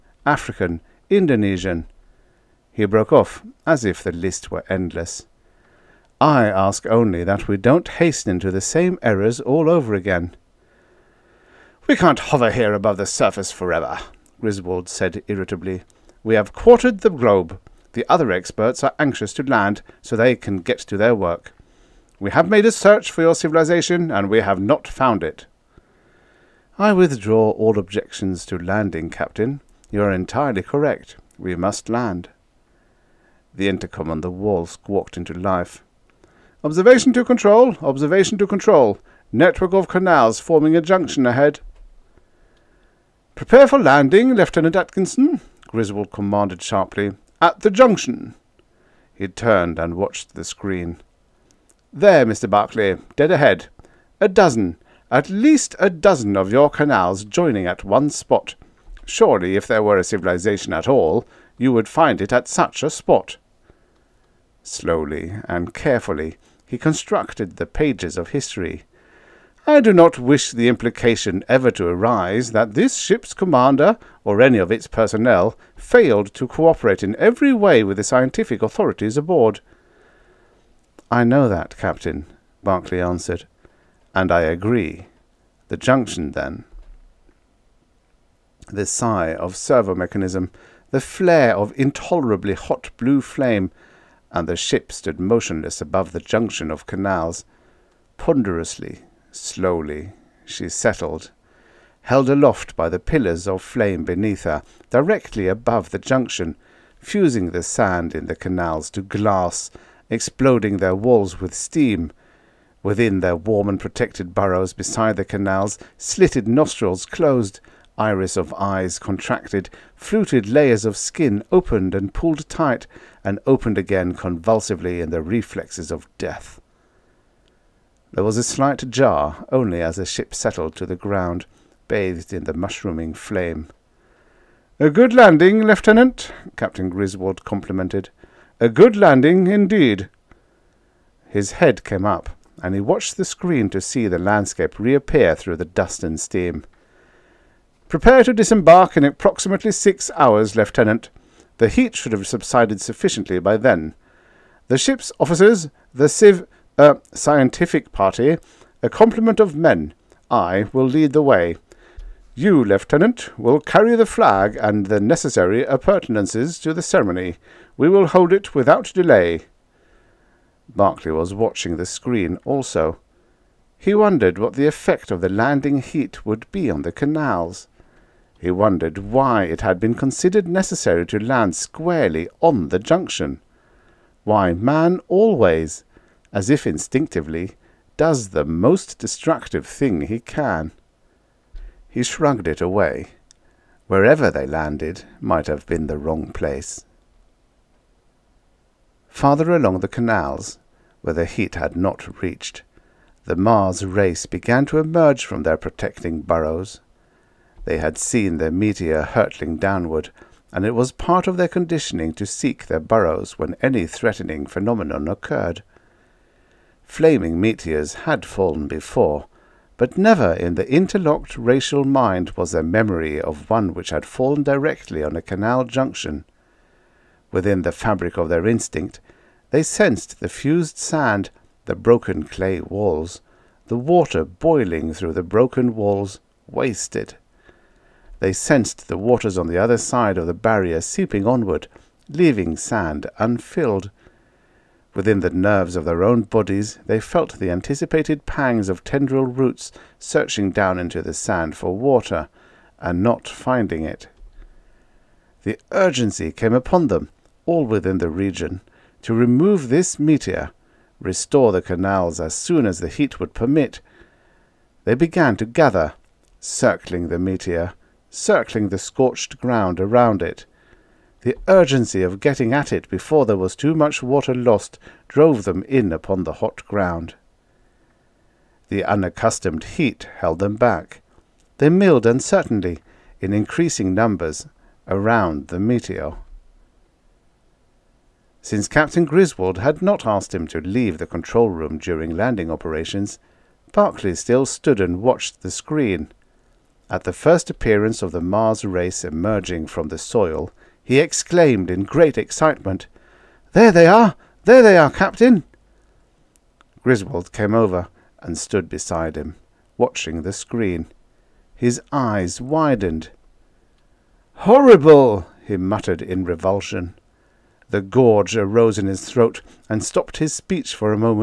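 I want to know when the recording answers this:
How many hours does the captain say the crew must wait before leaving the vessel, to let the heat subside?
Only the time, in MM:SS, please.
02:29.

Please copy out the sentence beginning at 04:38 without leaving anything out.
The unaccustomed heat held them back.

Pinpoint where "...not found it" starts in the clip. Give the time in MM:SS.
00:24.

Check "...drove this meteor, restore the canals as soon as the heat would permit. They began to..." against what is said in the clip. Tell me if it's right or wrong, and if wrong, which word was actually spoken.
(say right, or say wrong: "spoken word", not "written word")
wrong: "remove", not "drove".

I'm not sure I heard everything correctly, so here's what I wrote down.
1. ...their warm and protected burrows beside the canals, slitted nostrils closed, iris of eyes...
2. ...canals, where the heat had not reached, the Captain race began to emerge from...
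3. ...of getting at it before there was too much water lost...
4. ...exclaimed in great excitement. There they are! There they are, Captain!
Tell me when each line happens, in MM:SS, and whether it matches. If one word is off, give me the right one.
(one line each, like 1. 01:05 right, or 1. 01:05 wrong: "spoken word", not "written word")
1. 01:53 right
2. 03:19 wrong: "Mars", not "Captain"
3. 04:32 right
4. 05:00 right.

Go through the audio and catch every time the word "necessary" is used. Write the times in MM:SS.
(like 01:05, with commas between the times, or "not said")
02:44, 03:00.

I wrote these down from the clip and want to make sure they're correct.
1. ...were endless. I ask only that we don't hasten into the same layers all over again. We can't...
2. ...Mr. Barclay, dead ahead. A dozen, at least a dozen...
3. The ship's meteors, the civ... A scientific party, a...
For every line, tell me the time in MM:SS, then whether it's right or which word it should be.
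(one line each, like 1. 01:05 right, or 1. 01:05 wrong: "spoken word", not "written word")
1. 00:04 wrong: "errors", not "layers"
2. 00:52 right
3. 02:34 wrong: "officers", not "meteors".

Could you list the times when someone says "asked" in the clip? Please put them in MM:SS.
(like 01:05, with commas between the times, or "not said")
04:50.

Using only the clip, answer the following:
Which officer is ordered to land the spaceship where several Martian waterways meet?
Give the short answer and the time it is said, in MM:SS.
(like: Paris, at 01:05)
Lieutenant Atkinson, at 00:44.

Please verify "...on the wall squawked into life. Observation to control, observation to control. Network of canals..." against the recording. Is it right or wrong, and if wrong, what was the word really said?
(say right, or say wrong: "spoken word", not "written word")
right.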